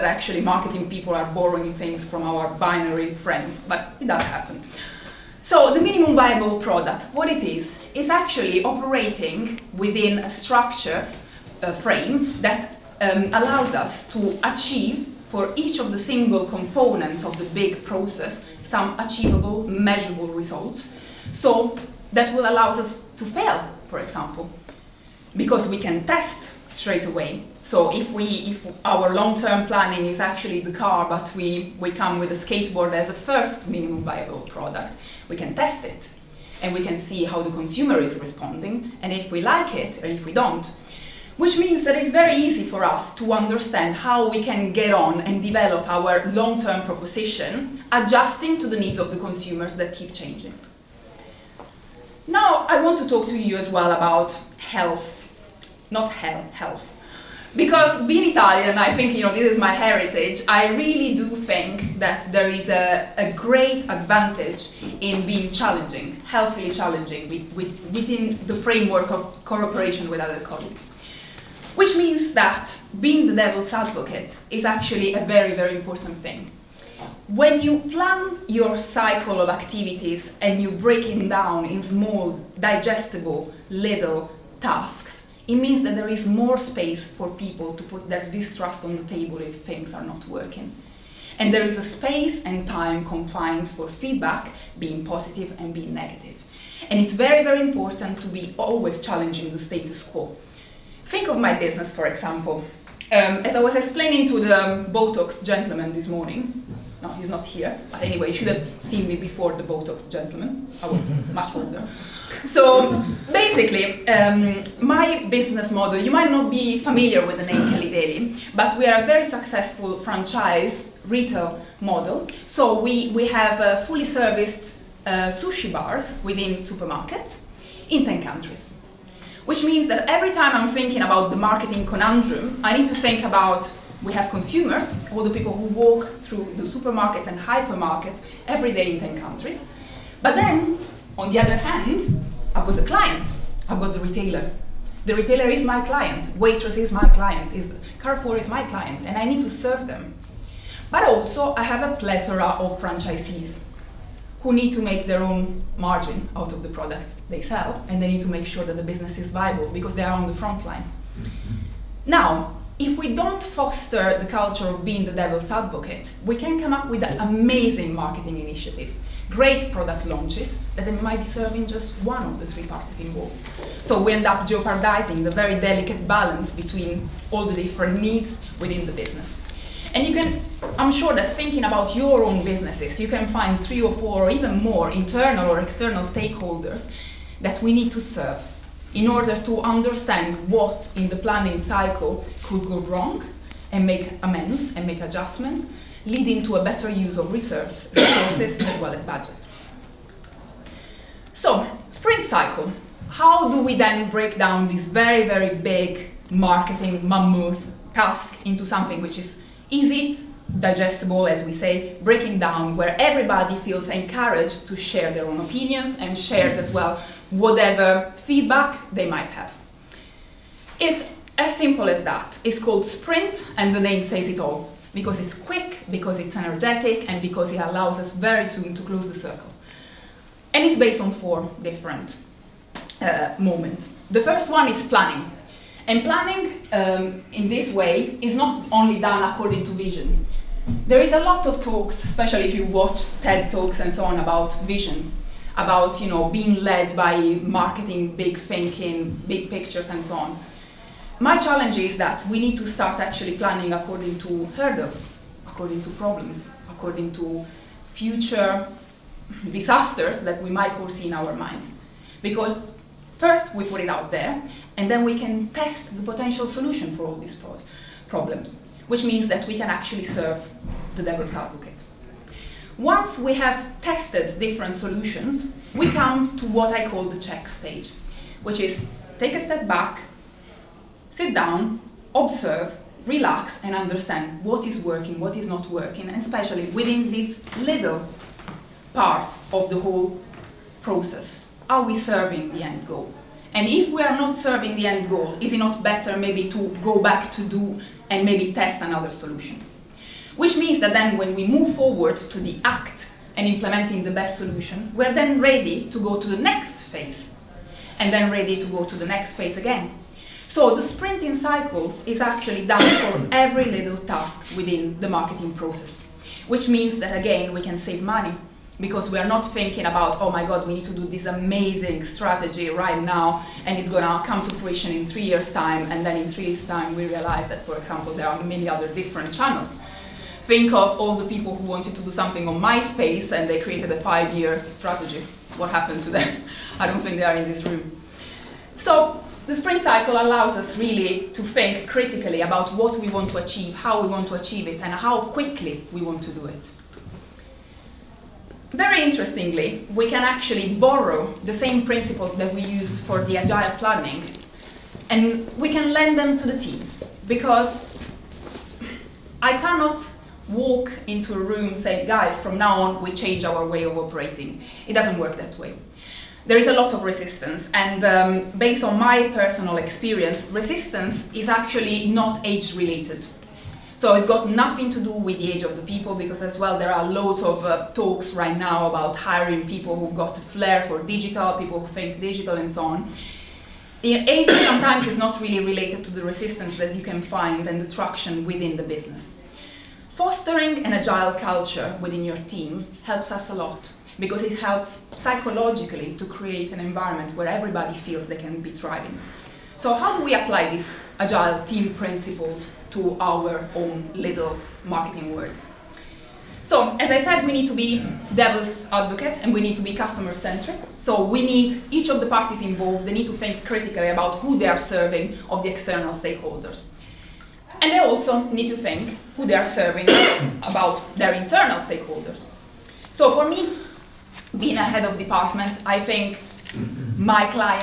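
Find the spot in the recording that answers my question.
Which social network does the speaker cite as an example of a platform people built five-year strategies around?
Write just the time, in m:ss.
5:32.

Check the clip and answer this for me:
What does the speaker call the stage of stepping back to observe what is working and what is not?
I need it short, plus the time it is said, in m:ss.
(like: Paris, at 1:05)
Check stage, at 4:37.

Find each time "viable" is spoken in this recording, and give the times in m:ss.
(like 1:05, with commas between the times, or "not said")
0:06, 0:34, 2:39.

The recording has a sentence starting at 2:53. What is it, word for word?
So we end up jeopardizing the very delicate balance between all the different needs within the business.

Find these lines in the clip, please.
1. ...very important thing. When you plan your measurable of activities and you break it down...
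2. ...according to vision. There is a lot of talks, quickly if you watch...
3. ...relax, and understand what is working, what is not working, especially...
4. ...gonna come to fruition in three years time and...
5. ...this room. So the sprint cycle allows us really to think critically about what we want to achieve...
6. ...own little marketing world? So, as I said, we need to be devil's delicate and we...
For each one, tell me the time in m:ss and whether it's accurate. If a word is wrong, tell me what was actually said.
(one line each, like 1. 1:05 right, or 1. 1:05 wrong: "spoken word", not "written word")
1. 1:15 wrong: "cycle", not "measurable"
2. 3:59 wrong: "especially", not "quickly"
3. 4:43 right
4. 5:23 right
5. 5:37 right
6. 6:43 wrong: "advocate", not "delicate".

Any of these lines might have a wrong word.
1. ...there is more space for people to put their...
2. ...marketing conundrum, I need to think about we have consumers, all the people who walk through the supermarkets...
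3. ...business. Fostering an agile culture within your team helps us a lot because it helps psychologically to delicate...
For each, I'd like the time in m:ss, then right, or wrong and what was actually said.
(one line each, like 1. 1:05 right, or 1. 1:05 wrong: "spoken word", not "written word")
1. 1:25 right
2. 2:11 right
3. 6:28 wrong: "create", not "delicate".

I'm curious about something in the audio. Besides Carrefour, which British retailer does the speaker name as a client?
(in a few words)
Waitrose.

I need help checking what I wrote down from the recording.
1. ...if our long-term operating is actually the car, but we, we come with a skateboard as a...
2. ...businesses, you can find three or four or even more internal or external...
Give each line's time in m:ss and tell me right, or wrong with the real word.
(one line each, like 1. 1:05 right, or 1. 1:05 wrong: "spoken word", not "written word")
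1. 0:28 wrong: "planning", not "operating"
2. 3:02 right.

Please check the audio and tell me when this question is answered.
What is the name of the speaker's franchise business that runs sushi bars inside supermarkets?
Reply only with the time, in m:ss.
1:57.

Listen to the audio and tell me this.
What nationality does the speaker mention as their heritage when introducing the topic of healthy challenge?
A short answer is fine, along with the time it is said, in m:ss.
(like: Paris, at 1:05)
Italian, at 0:58.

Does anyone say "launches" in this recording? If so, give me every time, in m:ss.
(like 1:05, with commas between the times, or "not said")
2:50.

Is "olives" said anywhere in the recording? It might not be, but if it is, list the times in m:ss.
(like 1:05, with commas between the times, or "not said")
not said.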